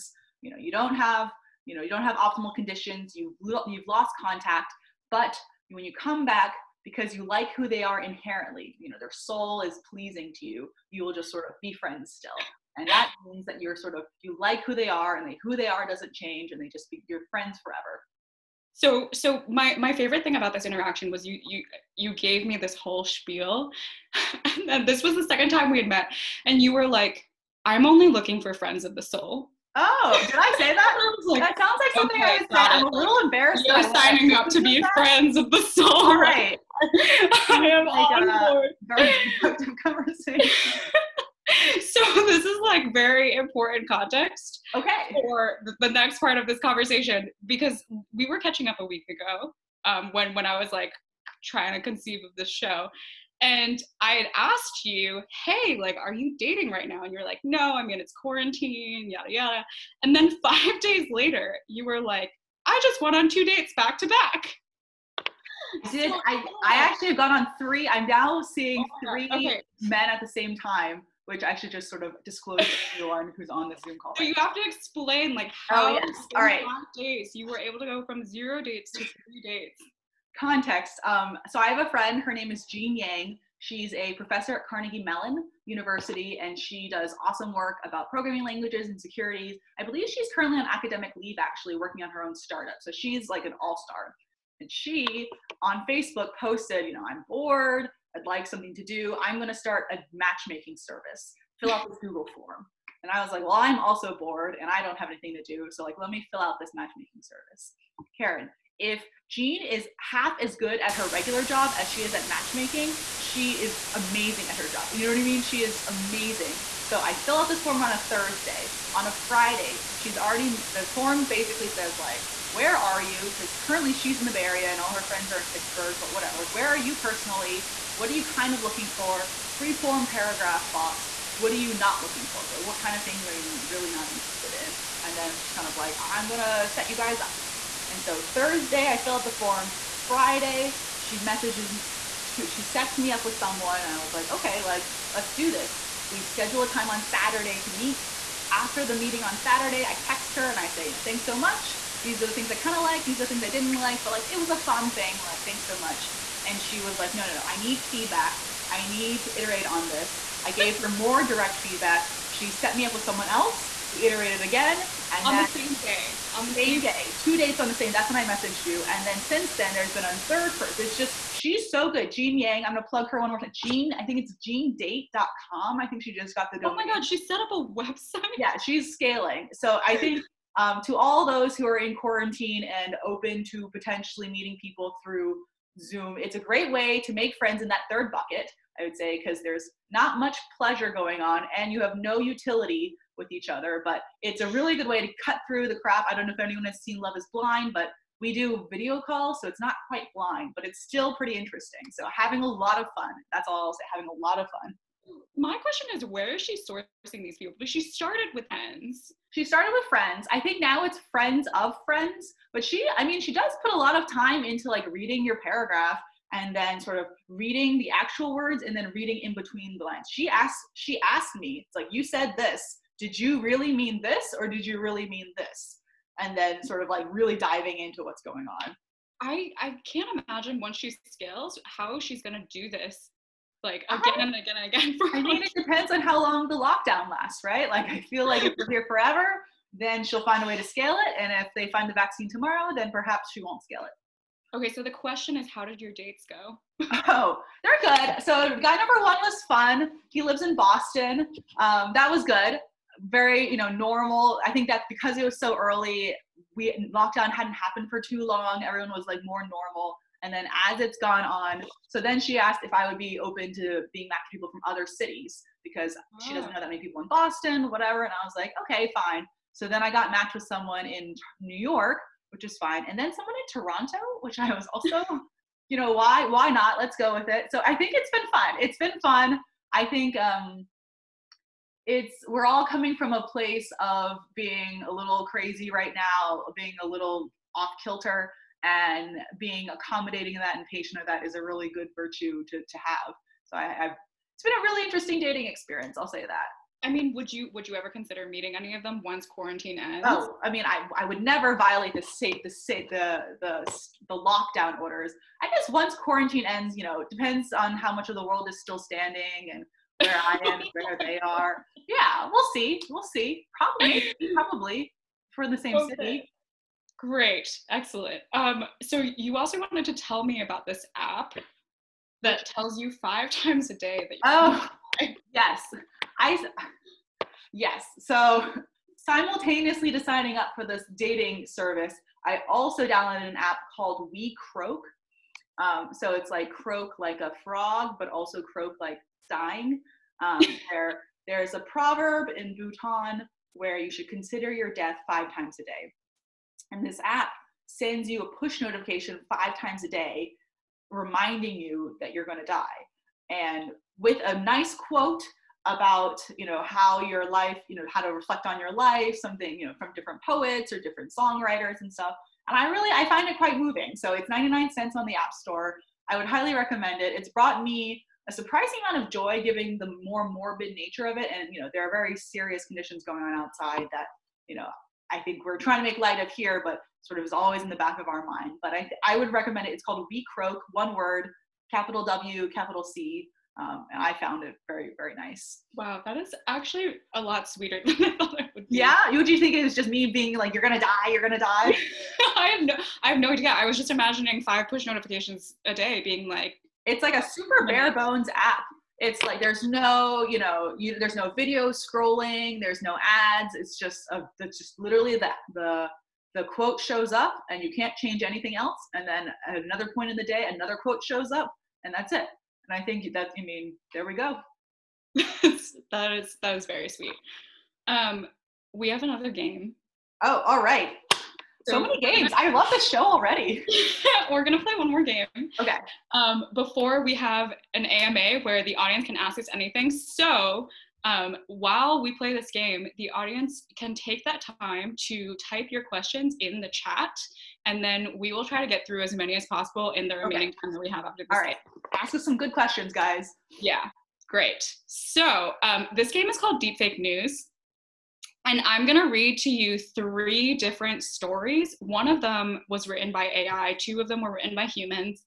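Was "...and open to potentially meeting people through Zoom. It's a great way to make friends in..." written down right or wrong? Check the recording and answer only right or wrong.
right.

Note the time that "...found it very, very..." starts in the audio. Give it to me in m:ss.
6:24.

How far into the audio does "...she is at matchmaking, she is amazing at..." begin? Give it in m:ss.
1:51.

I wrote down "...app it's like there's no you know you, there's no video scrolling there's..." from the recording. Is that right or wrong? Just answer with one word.
right.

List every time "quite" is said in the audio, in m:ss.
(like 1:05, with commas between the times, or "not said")
3:19, 6:03.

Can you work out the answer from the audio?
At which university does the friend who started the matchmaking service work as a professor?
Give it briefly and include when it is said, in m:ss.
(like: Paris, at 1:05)
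Carnegie Mellon University, at 1:24.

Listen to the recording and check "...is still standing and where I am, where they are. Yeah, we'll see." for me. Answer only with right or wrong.
right.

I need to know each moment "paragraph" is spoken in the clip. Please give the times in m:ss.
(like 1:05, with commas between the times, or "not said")
2:10, 3:35.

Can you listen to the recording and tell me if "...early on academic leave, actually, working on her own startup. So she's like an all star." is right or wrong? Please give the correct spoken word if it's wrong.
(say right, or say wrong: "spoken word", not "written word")
wrong: "currently", not "early".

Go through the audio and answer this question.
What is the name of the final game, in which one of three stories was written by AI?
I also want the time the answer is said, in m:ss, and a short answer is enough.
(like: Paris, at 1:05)
Deepfake News, at 7:26.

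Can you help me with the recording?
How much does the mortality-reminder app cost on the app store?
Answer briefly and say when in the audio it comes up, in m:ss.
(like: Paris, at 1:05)
99 cents, at 6:04.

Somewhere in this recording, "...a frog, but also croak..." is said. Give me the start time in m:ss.
5:37.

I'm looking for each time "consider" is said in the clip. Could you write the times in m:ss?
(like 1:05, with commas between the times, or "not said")
4:57, 5:44.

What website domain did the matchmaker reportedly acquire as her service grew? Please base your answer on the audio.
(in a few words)
jeandate.com.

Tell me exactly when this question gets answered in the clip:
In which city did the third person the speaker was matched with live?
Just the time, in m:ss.
4:33.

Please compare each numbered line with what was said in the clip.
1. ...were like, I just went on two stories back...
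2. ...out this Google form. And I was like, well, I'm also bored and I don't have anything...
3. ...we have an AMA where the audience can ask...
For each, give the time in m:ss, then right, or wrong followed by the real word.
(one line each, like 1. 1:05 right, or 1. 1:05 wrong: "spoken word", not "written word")
1. 1:01 wrong: "dates", not "stories"
2. 1:41 right
3. 7:07 right.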